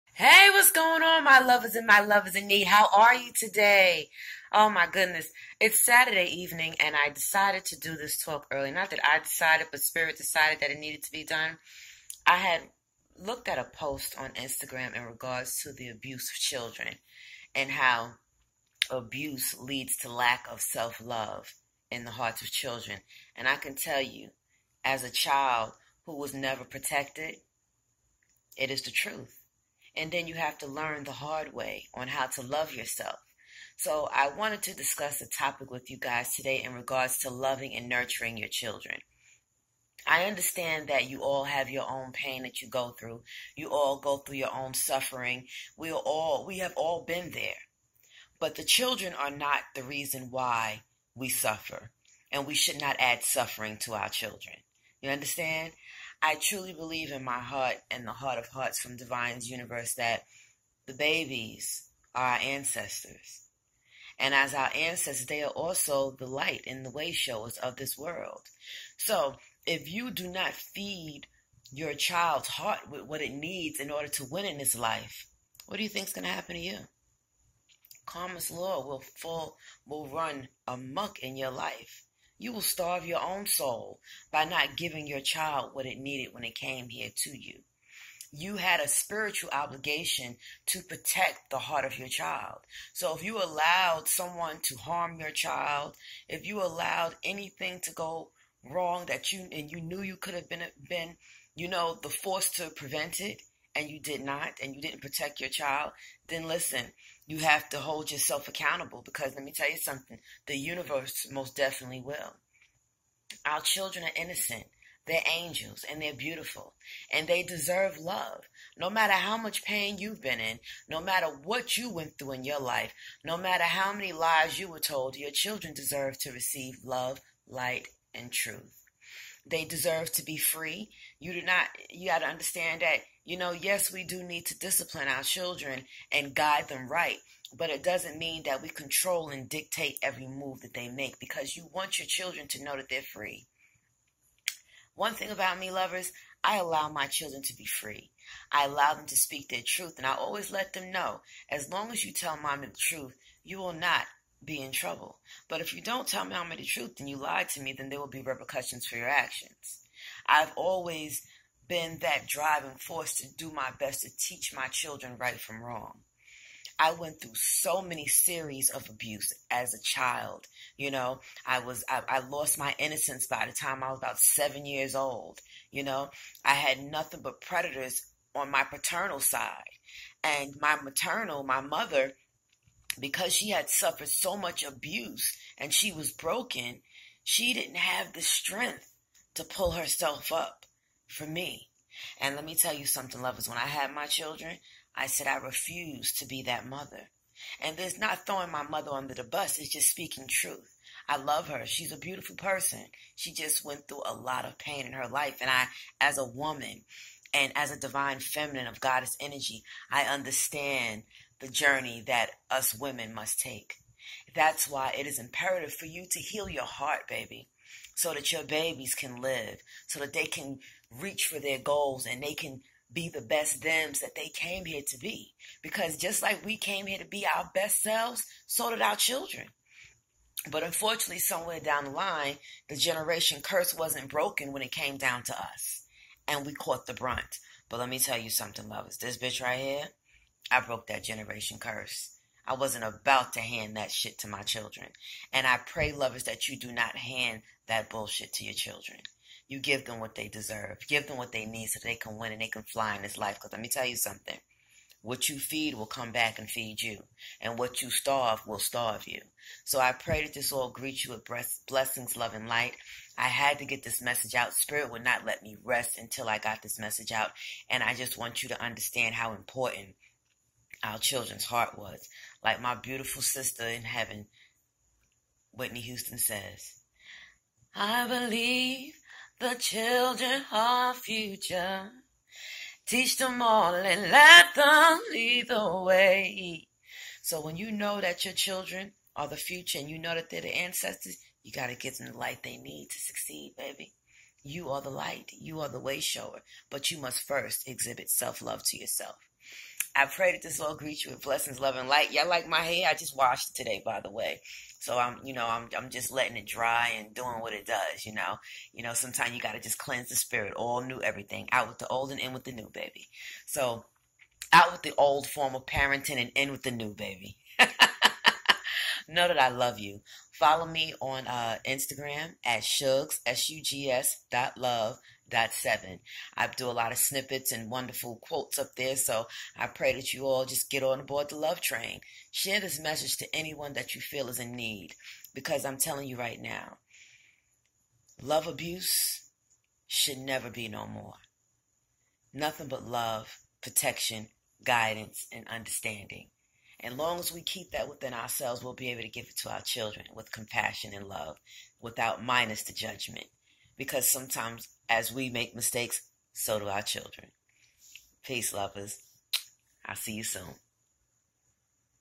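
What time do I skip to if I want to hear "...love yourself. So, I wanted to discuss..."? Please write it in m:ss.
0:32.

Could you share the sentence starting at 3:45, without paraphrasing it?
Because just like we came here to be our best selves, so did our children.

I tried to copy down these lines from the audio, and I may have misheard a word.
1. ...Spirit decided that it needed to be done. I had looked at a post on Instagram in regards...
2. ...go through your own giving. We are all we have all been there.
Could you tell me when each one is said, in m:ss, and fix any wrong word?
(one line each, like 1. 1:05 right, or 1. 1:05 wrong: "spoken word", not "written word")
1. 0:09 right
2. 0:43 wrong: "suffering", not "giving".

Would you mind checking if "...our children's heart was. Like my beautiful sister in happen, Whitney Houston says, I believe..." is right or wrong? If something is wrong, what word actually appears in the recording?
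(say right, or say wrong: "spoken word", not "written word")
wrong: "heaven", not "happen".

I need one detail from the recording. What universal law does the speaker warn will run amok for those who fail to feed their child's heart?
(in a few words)
Karma's law.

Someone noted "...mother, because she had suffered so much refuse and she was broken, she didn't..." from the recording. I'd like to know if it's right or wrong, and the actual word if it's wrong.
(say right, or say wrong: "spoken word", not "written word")
wrong: "abuse", not "refuse".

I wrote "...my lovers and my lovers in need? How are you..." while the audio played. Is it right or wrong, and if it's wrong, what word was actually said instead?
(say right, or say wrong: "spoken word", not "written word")
right.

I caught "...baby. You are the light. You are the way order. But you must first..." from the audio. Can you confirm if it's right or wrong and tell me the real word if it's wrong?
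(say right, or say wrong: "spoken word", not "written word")
wrong: "shower", not "order".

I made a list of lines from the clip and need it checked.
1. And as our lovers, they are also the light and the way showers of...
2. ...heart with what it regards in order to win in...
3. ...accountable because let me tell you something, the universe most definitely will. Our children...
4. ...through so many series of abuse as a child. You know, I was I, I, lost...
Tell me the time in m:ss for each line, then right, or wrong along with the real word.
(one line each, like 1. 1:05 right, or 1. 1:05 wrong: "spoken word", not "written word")
1. 1:04 wrong: "ancestors", not "lovers"
2. 1:12 wrong: "needs", not "regards"
3. 1:48 right
4. 2:47 right.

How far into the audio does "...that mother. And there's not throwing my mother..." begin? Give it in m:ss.
3:16.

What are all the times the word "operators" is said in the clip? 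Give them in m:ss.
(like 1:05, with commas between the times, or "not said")
not said.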